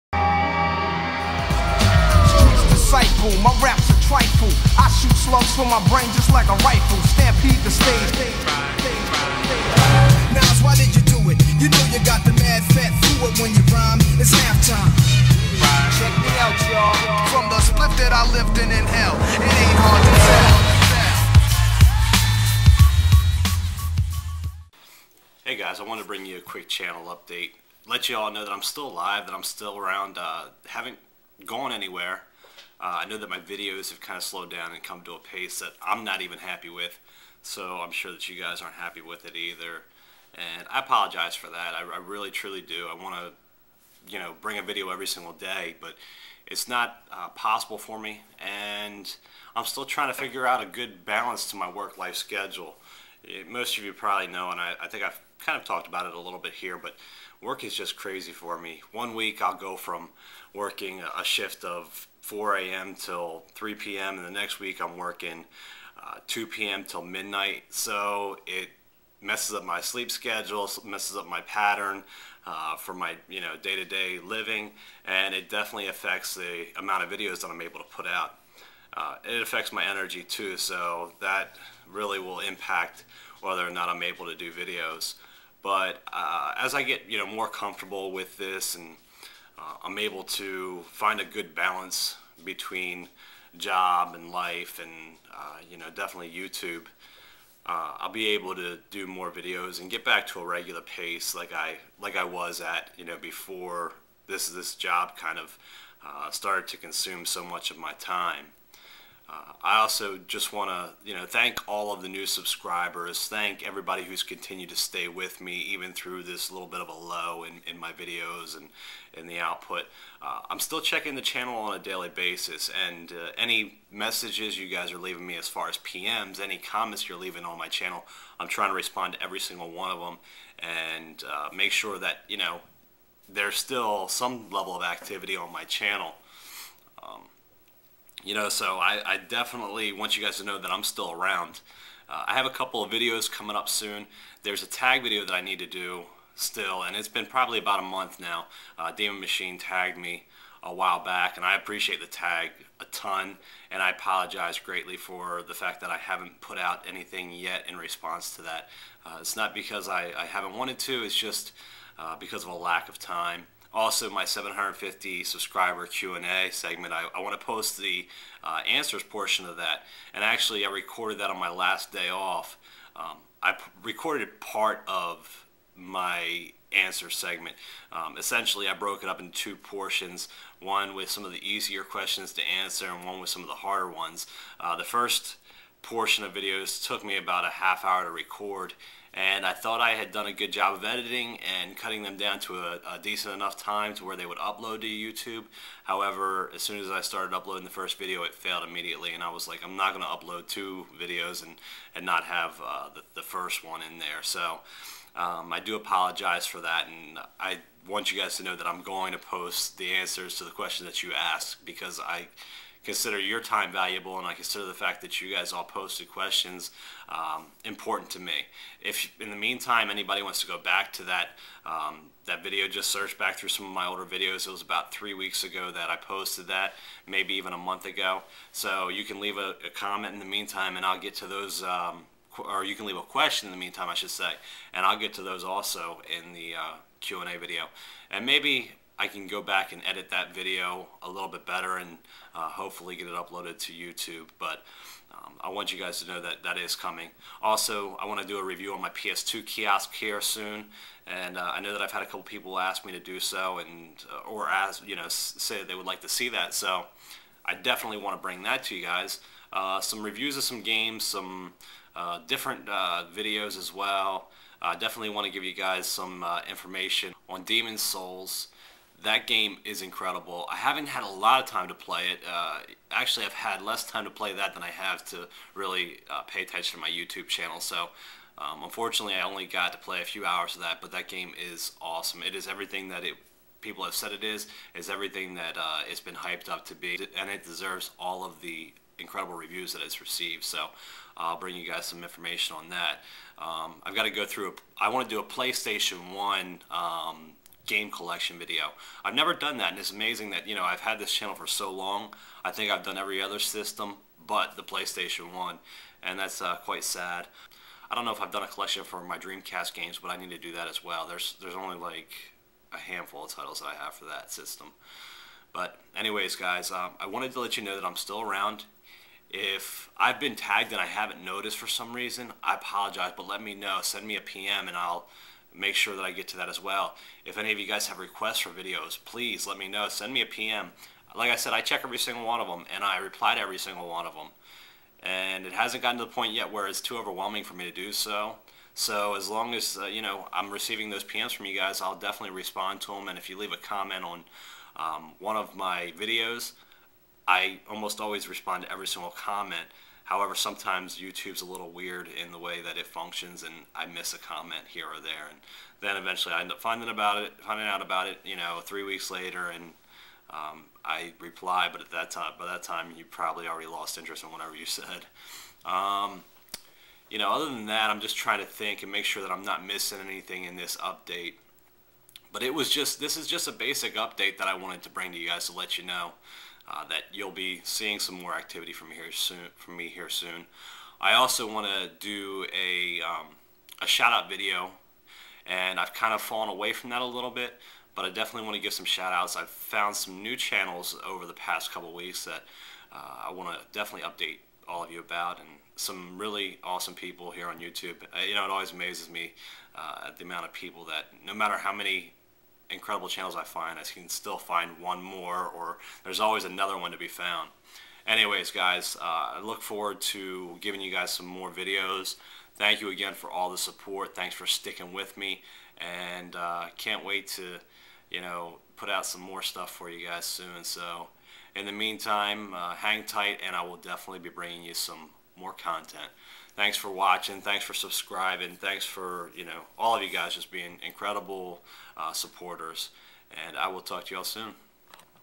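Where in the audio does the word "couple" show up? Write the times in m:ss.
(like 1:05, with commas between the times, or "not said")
2:22, 4:12, 6:31.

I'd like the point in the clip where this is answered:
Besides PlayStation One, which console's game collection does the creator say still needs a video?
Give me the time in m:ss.
5:09.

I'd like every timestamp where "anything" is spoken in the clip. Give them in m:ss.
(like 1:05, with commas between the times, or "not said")
2:36, 6:10.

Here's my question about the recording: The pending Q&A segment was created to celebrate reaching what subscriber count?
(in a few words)
750.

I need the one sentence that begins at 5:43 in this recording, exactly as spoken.
And if you leave a comment on um, one of my videos, I almost always respond to every single comment.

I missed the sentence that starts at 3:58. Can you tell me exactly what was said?
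And maybe I can go back and edit that video a little bit better and uh, hopefully get it uploaded to YouTube.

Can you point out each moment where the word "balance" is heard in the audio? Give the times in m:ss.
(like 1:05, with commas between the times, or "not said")
0:51, 1:31.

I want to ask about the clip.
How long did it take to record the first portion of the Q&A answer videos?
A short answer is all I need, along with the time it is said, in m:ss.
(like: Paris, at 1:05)
A half hour, at 3:07.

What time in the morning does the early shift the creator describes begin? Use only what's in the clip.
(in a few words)
4 a.m.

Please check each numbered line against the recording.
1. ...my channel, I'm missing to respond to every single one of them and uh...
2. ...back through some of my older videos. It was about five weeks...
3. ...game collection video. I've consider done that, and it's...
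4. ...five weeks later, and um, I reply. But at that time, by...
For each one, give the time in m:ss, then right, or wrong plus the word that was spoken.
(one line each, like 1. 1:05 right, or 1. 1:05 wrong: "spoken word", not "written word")
1. 2:07 wrong: "trying", not "missing"
2. 3:43 wrong: "three", not "five"
3. 4:57 wrong: "never", not "consider"
4. 5:58 wrong: "three", not "five".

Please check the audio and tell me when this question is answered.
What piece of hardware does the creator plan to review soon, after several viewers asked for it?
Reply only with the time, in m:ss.
4:08.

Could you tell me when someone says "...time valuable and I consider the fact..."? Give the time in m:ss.
3:33.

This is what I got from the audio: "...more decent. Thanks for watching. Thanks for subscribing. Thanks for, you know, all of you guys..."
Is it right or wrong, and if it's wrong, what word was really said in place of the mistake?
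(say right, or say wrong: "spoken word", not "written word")
wrong: "content", not "decent".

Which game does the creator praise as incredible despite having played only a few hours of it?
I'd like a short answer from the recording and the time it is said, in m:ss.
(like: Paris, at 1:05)
Demon Souls, at 4:27.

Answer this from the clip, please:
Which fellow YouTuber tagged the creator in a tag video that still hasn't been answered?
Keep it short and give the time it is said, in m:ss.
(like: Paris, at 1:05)
Demon Machine, at 2:28.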